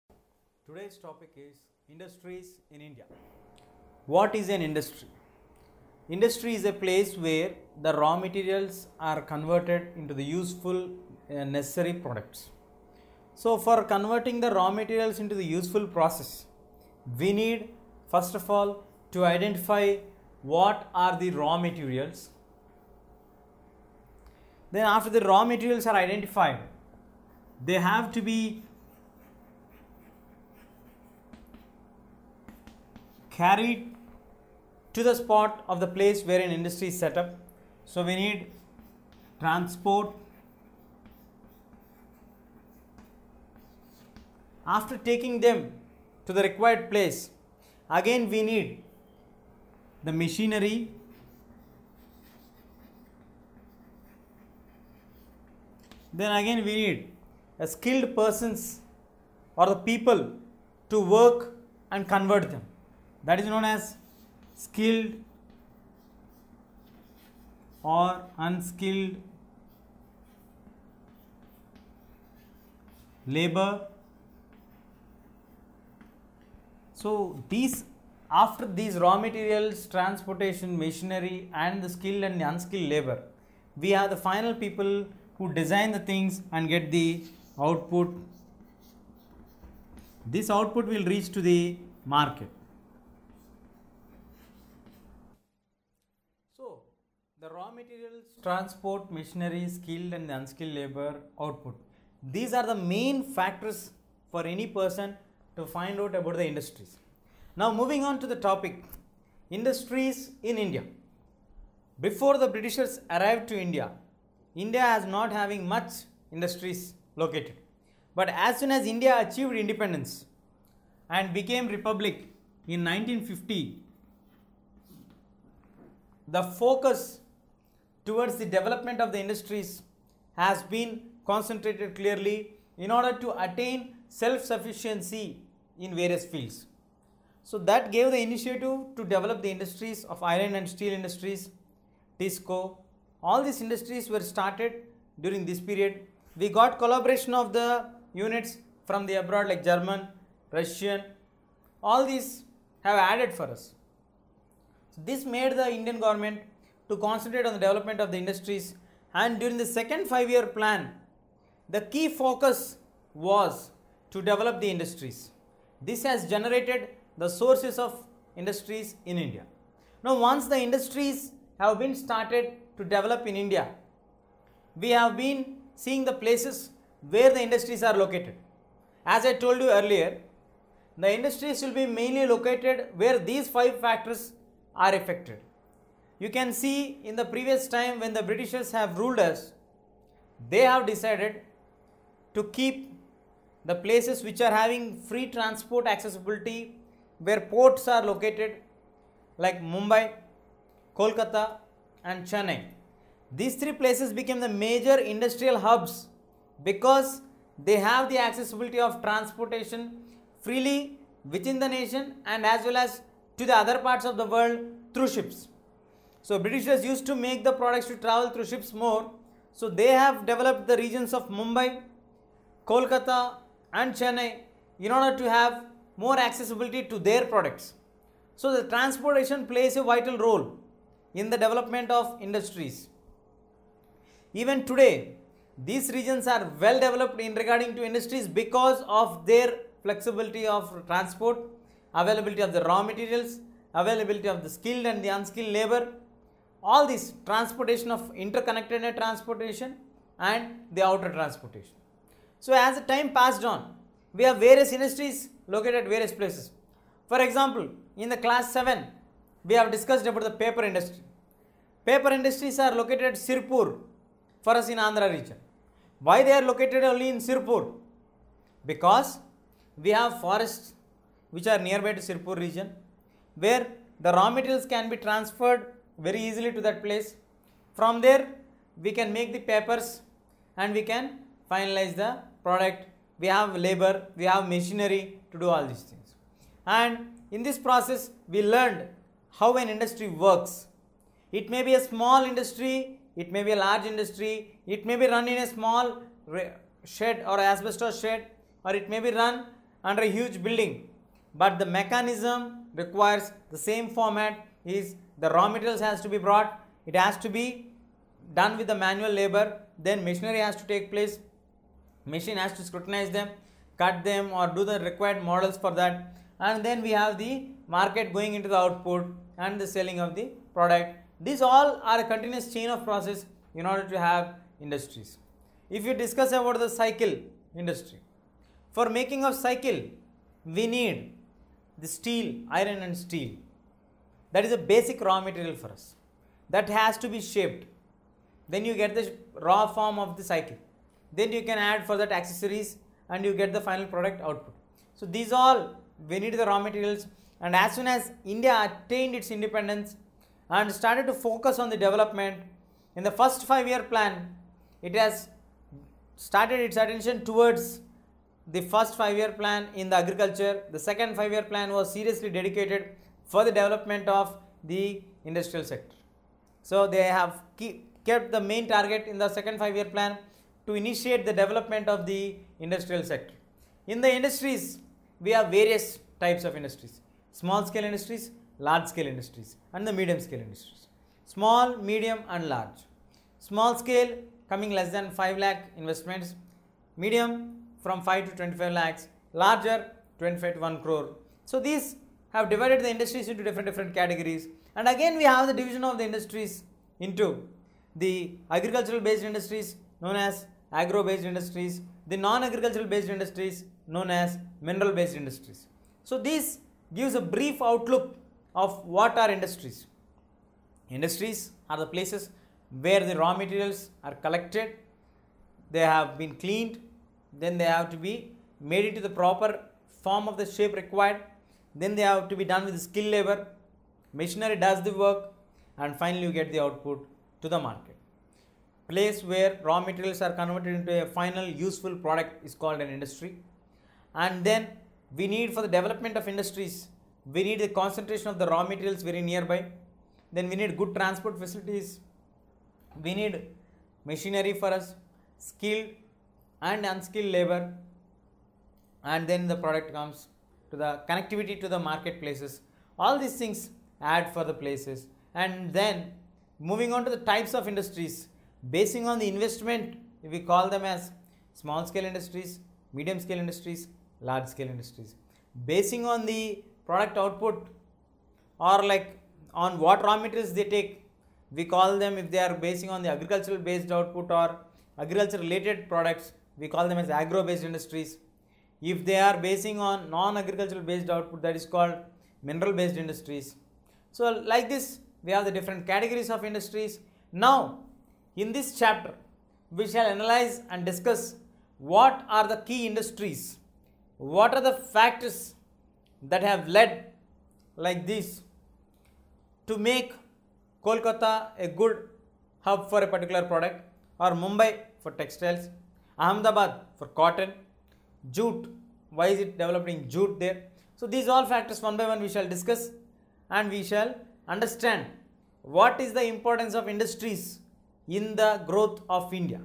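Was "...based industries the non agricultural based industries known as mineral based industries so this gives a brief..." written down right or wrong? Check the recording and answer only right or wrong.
right.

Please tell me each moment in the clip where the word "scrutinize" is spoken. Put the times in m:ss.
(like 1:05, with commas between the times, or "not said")
5:12.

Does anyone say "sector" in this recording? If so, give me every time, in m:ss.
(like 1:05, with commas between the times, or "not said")
6:05, 6:13.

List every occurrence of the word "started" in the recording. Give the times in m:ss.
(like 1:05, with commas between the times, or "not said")
2:24, 2:51, 5:50, 5:56.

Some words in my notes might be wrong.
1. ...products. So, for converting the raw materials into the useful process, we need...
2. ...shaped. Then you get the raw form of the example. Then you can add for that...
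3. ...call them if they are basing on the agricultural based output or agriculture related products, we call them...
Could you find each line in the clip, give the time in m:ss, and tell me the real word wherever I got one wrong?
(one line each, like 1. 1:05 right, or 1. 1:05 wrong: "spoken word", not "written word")
1. 0:11 right
2. 5:37 wrong: "cycle", not "example"
3. 7:51 right.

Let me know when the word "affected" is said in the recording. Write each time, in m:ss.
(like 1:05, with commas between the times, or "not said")
3:04.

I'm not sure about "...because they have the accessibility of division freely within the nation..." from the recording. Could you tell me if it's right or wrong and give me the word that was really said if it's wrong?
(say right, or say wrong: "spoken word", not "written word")
wrong: "transportation", not "division".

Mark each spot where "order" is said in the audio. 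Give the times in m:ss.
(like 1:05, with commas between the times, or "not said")
2:12, 3:44, 5:23.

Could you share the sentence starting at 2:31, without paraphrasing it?
All these have added for us.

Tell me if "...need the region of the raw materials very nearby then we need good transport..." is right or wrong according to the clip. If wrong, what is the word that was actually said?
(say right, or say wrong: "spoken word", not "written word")
wrong: "concentration", not "region".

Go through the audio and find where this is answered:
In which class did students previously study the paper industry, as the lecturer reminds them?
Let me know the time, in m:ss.
4:18.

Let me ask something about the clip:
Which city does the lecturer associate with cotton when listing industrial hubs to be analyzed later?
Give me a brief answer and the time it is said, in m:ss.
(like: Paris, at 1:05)
Ahmedabad, at 8:26.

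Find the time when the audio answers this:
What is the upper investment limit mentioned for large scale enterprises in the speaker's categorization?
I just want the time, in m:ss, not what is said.
6:30.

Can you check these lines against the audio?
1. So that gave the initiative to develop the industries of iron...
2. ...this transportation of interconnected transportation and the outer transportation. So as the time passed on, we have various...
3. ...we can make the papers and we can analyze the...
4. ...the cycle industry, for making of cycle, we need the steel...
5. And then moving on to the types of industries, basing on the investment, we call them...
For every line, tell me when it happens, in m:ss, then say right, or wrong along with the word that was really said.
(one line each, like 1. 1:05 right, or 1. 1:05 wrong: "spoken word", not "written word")
1. 2:17 right
2. 4:06 right
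3. 4:38 wrong: "finalize", not "analyze"
4. 5:26 right
5. 7:35 right.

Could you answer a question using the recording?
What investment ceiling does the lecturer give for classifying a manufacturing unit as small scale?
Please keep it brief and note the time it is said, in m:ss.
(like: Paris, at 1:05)
5 lakh, at 6:25.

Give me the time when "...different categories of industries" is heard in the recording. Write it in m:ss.
8:05.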